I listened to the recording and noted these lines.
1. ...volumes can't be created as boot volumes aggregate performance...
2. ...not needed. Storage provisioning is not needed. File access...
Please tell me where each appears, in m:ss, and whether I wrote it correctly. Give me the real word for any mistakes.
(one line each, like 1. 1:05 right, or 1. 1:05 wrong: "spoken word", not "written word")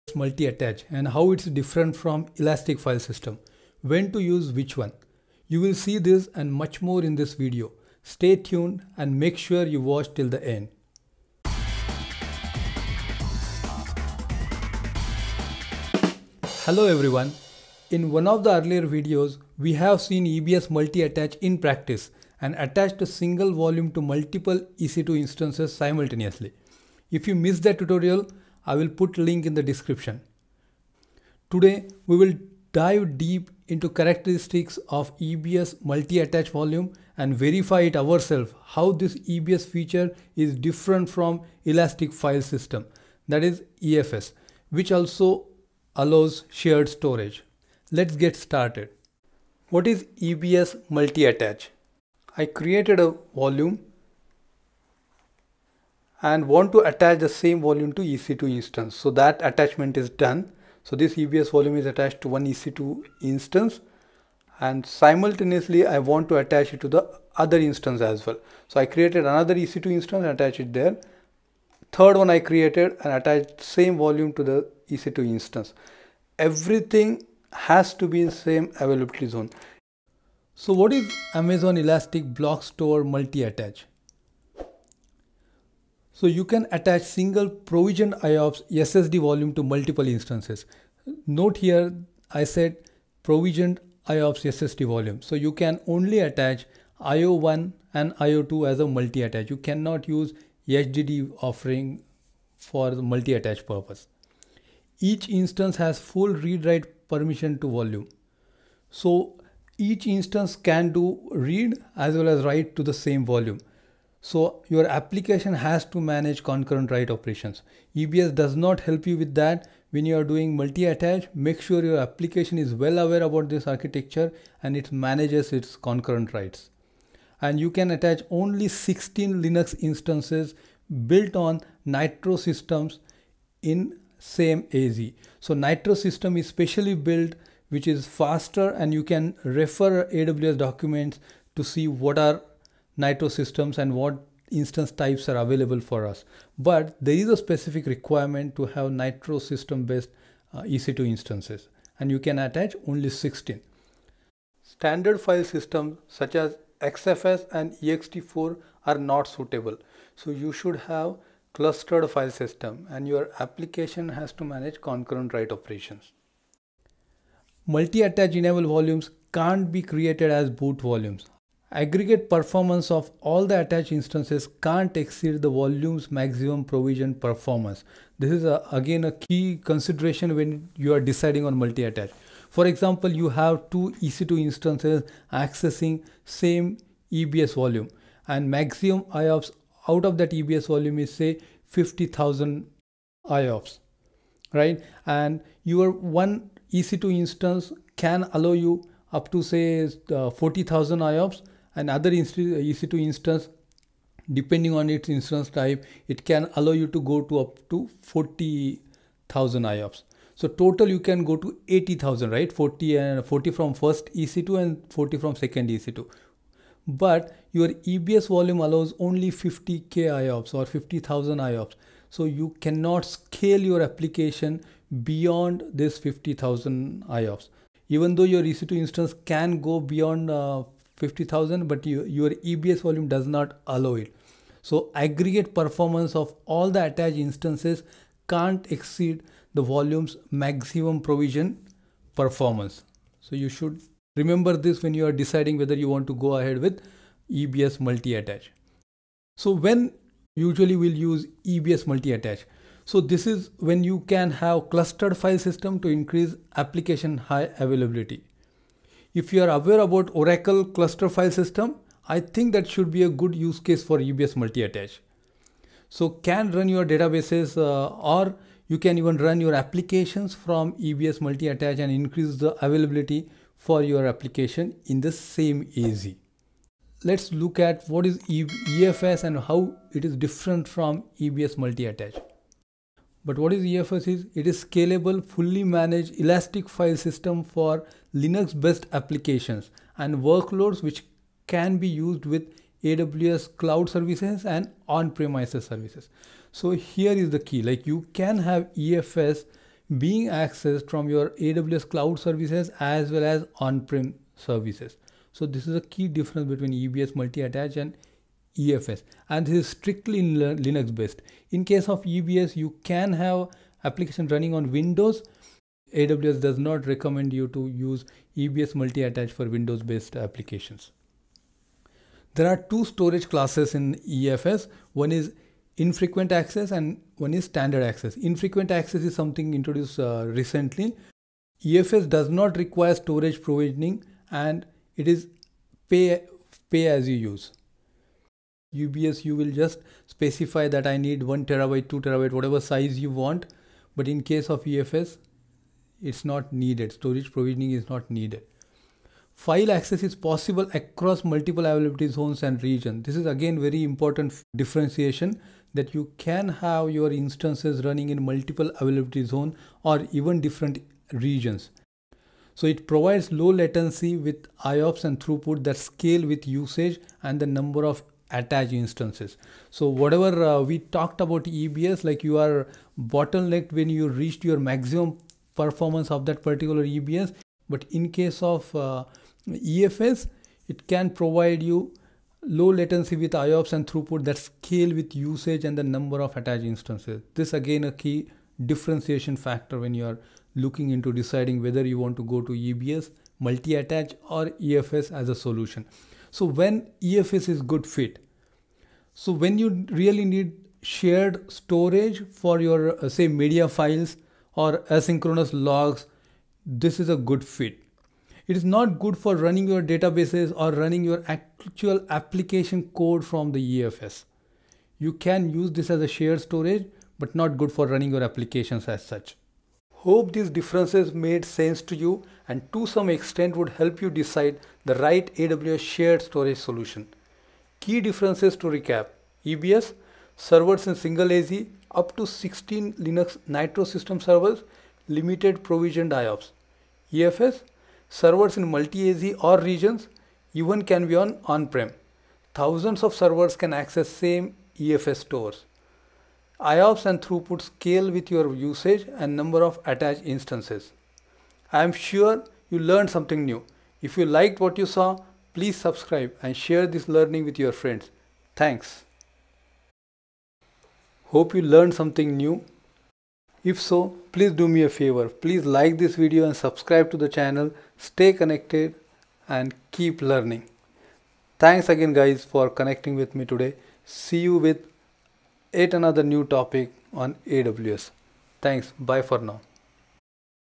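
1. 2:48 right
2. 5:46 right.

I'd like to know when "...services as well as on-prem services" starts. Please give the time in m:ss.
5:02.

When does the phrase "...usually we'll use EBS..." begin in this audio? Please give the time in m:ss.
4:10.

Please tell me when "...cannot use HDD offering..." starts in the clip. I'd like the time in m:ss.
1:39.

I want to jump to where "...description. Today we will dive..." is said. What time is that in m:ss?
0:29.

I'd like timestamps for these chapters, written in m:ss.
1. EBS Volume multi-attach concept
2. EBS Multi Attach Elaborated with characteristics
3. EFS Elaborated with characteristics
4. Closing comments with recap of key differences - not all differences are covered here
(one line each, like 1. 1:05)
1. 0:45
2. 1:19
3. 4:36
4. 7:07.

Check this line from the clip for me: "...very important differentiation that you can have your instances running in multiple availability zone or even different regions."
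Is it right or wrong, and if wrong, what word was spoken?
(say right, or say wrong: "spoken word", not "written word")
right.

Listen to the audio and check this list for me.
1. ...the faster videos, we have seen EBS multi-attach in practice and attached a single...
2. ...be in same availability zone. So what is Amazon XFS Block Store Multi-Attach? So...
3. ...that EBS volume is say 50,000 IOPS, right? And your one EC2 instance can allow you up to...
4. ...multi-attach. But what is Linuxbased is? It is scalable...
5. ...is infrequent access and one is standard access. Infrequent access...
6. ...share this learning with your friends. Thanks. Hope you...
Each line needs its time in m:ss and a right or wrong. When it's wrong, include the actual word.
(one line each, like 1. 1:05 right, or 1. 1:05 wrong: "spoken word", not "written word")
1. 0:18 wrong: "earlier", not "faster"
2. 1:18 wrong: "Elastic", not "XFS"
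3. 3:10 right
4. 4:41 wrong: "EFS", not "Linuxbased"
5. 5:25 right
6. 7:36 right.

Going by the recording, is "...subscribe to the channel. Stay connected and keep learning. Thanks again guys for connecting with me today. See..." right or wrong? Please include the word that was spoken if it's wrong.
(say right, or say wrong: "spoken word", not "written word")
right.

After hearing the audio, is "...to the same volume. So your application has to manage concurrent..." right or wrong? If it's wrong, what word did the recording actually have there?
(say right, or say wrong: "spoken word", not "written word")
right.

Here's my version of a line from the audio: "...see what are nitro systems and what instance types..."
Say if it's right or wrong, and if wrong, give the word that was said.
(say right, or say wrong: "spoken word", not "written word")
right.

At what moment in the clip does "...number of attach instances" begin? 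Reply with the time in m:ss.
6:07.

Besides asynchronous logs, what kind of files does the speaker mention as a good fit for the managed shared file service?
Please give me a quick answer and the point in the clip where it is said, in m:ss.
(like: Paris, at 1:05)
Media files, at 6:43.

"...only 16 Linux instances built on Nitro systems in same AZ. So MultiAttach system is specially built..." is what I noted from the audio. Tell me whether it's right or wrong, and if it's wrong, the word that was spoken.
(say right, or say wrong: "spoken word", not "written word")
wrong: "Nitro", not "MultiAttach".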